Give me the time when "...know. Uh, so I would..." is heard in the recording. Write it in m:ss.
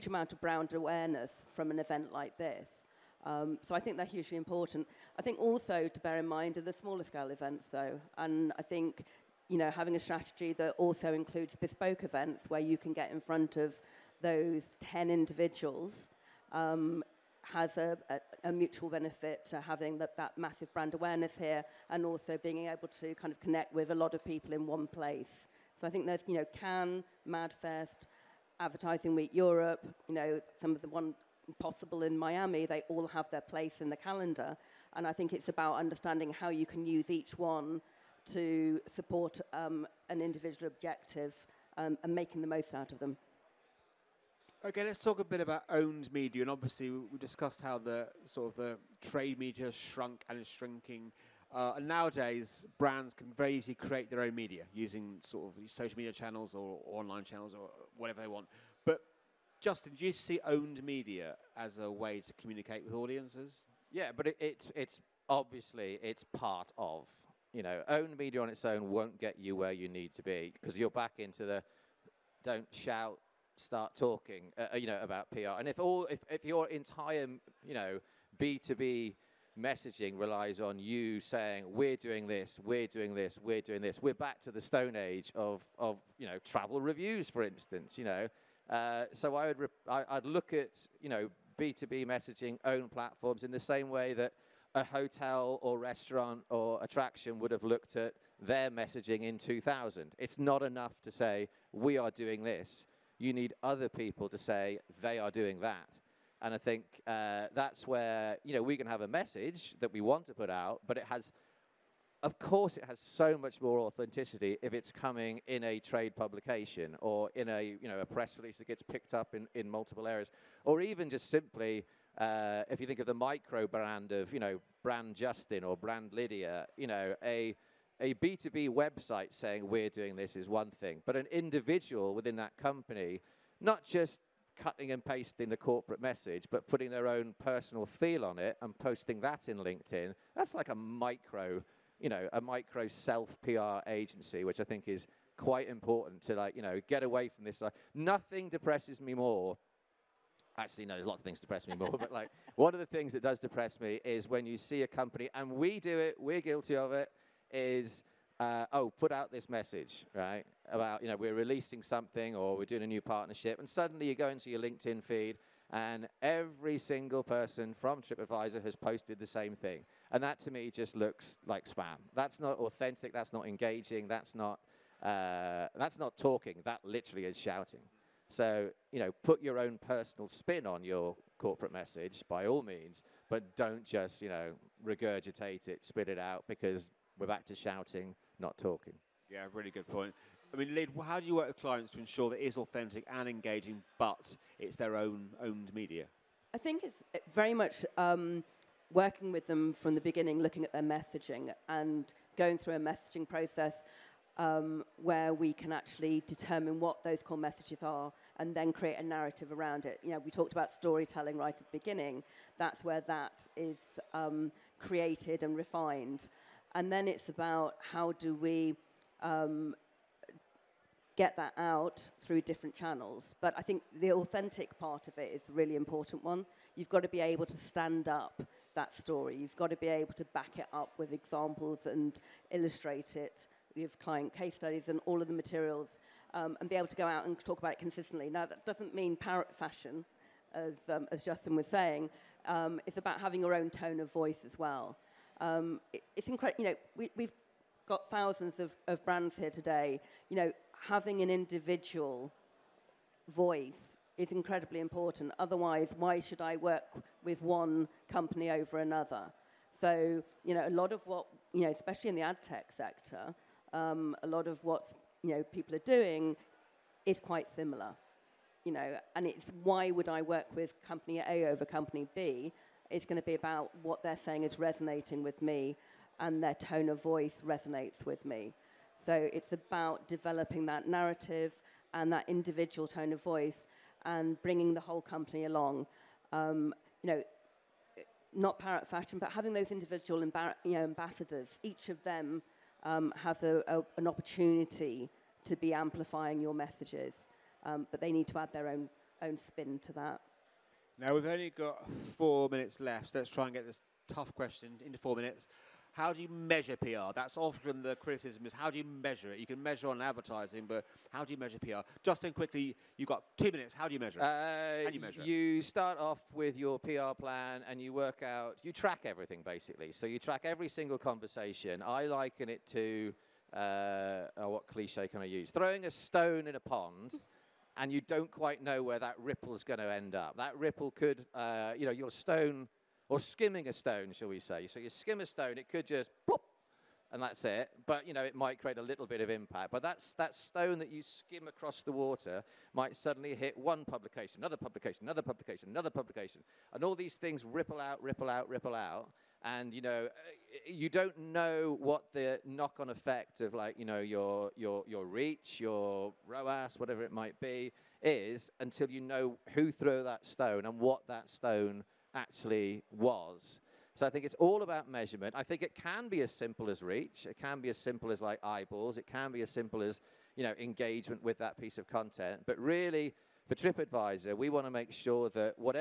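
1:28.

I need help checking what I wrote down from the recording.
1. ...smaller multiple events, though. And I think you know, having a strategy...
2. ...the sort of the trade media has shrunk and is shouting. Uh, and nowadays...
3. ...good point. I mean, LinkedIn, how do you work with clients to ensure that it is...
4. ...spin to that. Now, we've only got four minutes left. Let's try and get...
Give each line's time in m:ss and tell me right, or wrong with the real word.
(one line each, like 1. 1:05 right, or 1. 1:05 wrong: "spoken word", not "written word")
1. 0:06 wrong: "scale", not "multiple"
2. 0:47 wrong: "shrinking", not "shouting"
3. 3:09 wrong: "Lid", not "LinkedIn"
4. 4:59 right.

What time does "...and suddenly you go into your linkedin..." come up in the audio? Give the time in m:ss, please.
2:43.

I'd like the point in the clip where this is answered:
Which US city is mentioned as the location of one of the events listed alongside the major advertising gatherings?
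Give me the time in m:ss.
0:32.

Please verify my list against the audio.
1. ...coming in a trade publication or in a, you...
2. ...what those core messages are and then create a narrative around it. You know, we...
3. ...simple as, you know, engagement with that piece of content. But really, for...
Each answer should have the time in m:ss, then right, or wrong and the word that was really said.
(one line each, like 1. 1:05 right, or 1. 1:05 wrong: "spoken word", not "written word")
1. 1:54 right
2. 3:26 right
3. 6:09 right.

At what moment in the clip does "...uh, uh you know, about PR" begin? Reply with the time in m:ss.
1:14.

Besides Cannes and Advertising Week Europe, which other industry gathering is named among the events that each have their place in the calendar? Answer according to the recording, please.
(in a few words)
MadFest.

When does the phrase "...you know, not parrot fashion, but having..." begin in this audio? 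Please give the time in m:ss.
4:47.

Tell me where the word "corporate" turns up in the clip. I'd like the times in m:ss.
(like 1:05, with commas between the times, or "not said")
2:15, 3:01.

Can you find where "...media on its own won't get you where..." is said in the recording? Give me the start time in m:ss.
1:08.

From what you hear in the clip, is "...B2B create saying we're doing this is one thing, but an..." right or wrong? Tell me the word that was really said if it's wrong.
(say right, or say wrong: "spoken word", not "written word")
wrong: "website", not "create".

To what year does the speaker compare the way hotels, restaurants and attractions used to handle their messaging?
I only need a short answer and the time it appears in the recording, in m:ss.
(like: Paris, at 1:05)
2000, at 1:39.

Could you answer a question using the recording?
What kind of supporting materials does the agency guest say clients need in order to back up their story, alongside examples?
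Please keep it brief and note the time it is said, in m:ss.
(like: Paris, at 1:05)
Client case studies, at 3:53.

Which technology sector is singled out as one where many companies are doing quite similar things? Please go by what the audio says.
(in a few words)
Ad tech.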